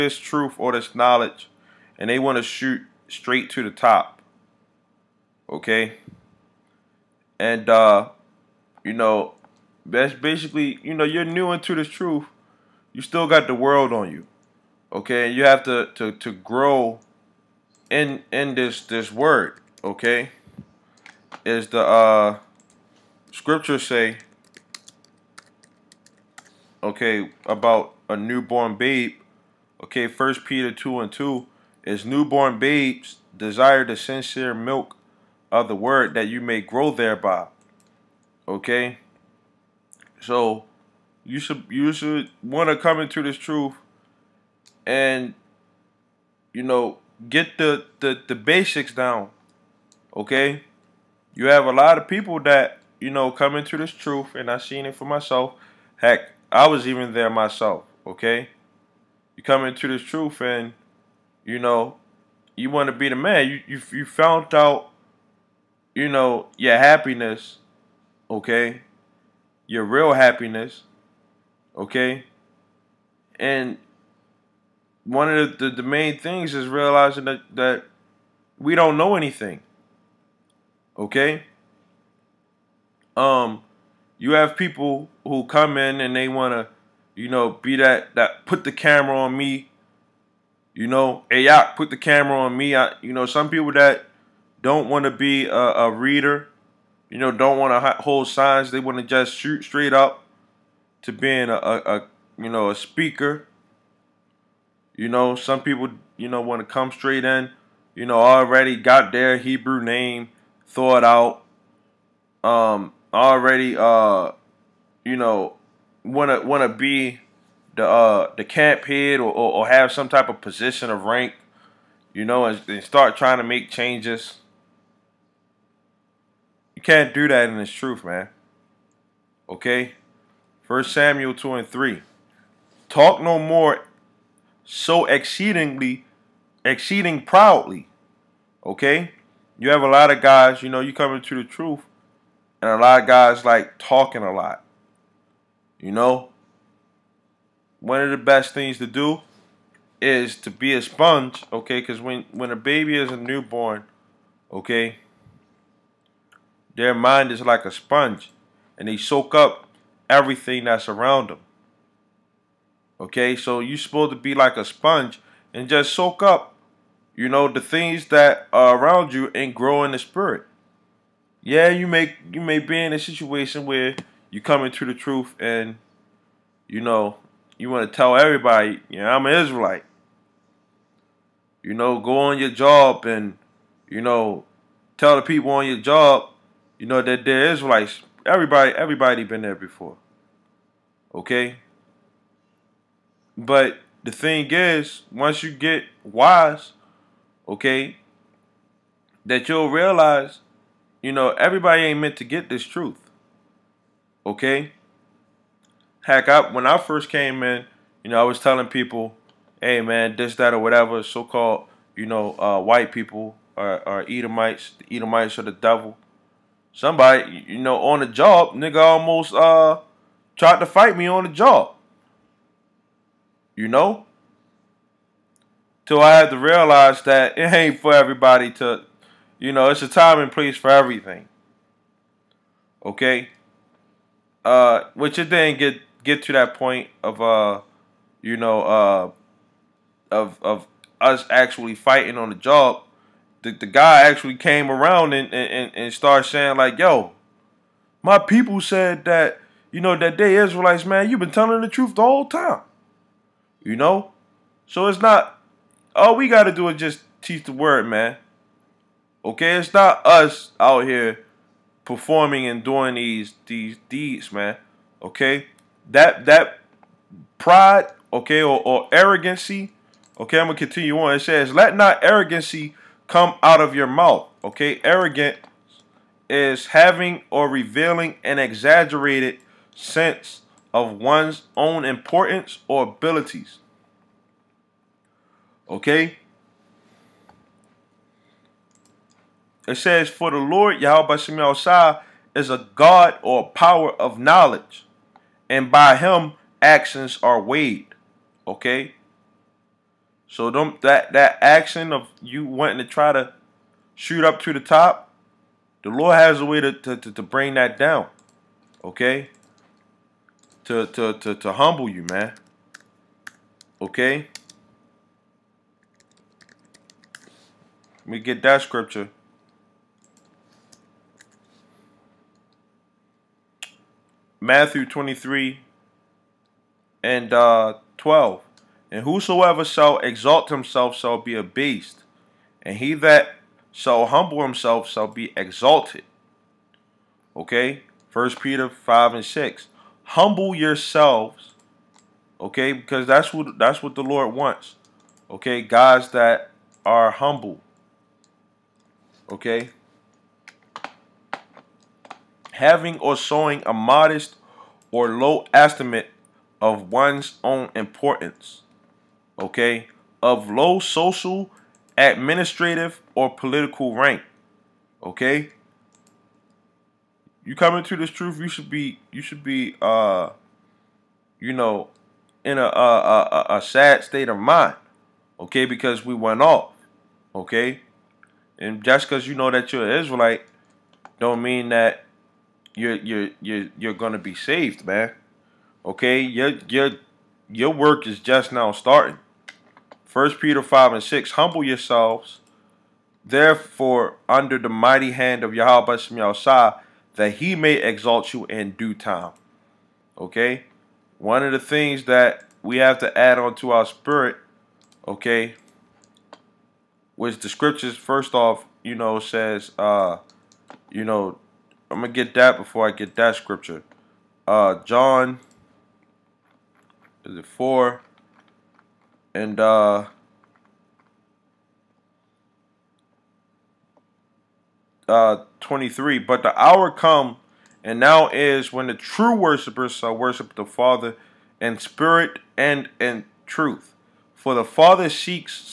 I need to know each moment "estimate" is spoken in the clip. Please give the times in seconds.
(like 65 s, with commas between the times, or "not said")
355 s.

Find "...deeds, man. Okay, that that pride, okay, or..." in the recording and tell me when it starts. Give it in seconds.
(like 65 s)
263 s.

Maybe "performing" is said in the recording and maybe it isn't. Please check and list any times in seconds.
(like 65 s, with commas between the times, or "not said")
261 s.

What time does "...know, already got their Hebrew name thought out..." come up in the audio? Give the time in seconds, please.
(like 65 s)
108 s.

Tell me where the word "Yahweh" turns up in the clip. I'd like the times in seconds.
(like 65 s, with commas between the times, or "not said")
290 s, 395 s.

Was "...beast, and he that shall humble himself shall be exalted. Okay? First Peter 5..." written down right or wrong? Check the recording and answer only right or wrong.
right.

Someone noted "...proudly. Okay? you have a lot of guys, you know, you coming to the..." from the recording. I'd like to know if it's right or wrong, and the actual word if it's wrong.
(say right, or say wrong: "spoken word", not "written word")
right.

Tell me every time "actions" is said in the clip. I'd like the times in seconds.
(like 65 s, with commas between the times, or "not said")
296 s, 301 s.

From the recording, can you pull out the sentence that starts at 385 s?
Okay, your your your work is just now starting.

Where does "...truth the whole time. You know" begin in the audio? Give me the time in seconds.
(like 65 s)
251 s.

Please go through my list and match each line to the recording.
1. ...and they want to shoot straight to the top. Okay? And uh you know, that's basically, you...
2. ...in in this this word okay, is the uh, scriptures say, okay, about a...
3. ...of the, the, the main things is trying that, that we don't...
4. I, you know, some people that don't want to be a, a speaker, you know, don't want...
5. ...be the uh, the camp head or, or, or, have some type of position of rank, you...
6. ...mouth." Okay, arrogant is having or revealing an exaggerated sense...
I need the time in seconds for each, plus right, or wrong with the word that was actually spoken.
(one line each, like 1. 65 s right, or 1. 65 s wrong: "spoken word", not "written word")
1. 1 s right
2. 17 s right
3. 75 s wrong: "realizing", not "trying"
4. 92 s wrong: "reader", not "speaker"
5. 116 s right
6. 273 s right.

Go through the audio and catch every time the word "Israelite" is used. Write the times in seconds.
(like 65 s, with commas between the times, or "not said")
179 s, 187 s, 250 s, 379 s.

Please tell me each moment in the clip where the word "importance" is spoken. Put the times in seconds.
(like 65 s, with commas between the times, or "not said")
281 s, 357 s.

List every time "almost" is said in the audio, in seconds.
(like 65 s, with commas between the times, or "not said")
218 s.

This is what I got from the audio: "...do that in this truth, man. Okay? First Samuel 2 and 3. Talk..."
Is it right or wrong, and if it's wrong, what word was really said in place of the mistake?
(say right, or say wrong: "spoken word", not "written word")
right.